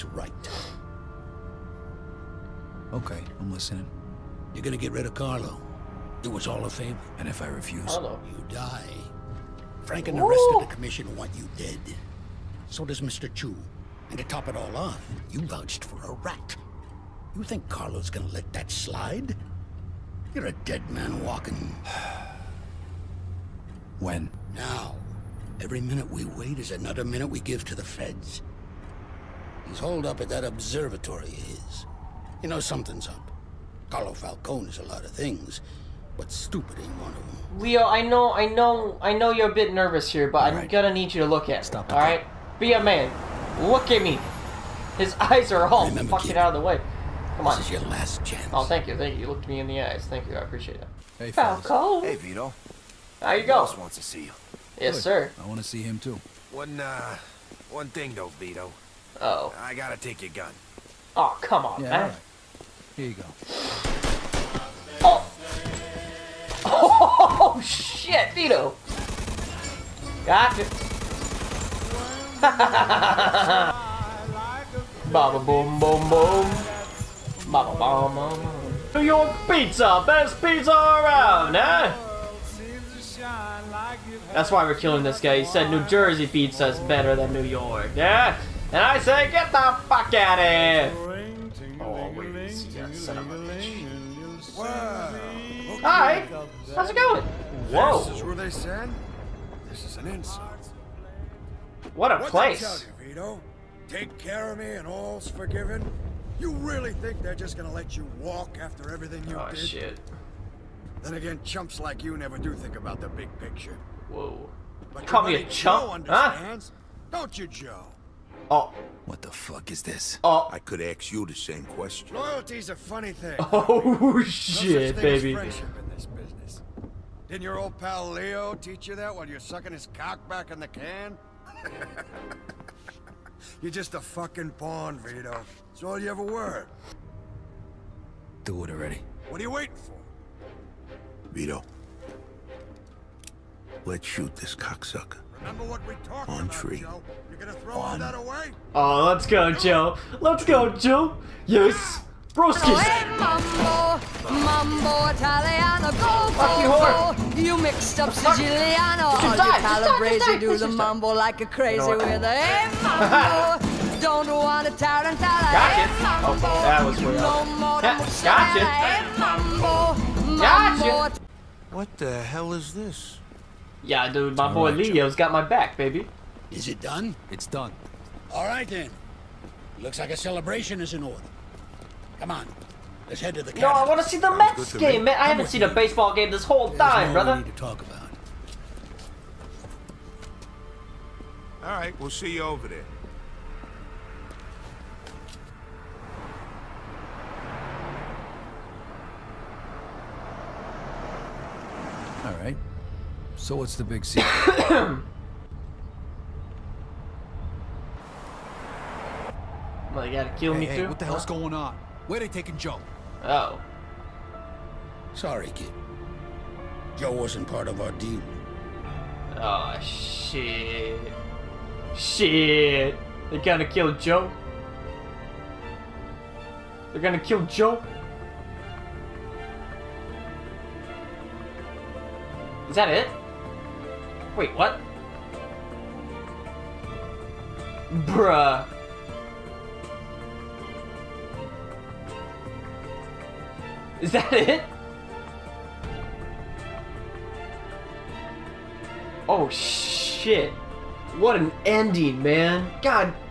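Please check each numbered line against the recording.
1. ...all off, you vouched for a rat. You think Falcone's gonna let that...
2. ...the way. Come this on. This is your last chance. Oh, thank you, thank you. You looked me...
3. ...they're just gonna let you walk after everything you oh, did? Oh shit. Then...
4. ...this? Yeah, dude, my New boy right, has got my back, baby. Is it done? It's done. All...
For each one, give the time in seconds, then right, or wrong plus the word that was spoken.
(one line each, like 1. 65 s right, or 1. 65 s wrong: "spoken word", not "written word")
1. 14 s wrong: "Carlo", not "Falcone"
2. 46 s right
3. 107 s right
4. 172 s wrong: "All", not "New".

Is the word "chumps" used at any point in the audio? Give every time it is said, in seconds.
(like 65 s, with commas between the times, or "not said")
111 s, 115 s.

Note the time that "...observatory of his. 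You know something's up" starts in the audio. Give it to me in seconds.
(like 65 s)
30 s.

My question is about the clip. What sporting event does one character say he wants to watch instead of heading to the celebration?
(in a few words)
The Mets game.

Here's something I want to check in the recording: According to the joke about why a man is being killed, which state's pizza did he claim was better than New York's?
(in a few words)
New Jersey.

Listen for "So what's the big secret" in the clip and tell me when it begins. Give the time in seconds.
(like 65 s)
203 s.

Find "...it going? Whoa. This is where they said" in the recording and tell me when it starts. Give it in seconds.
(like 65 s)
96 s.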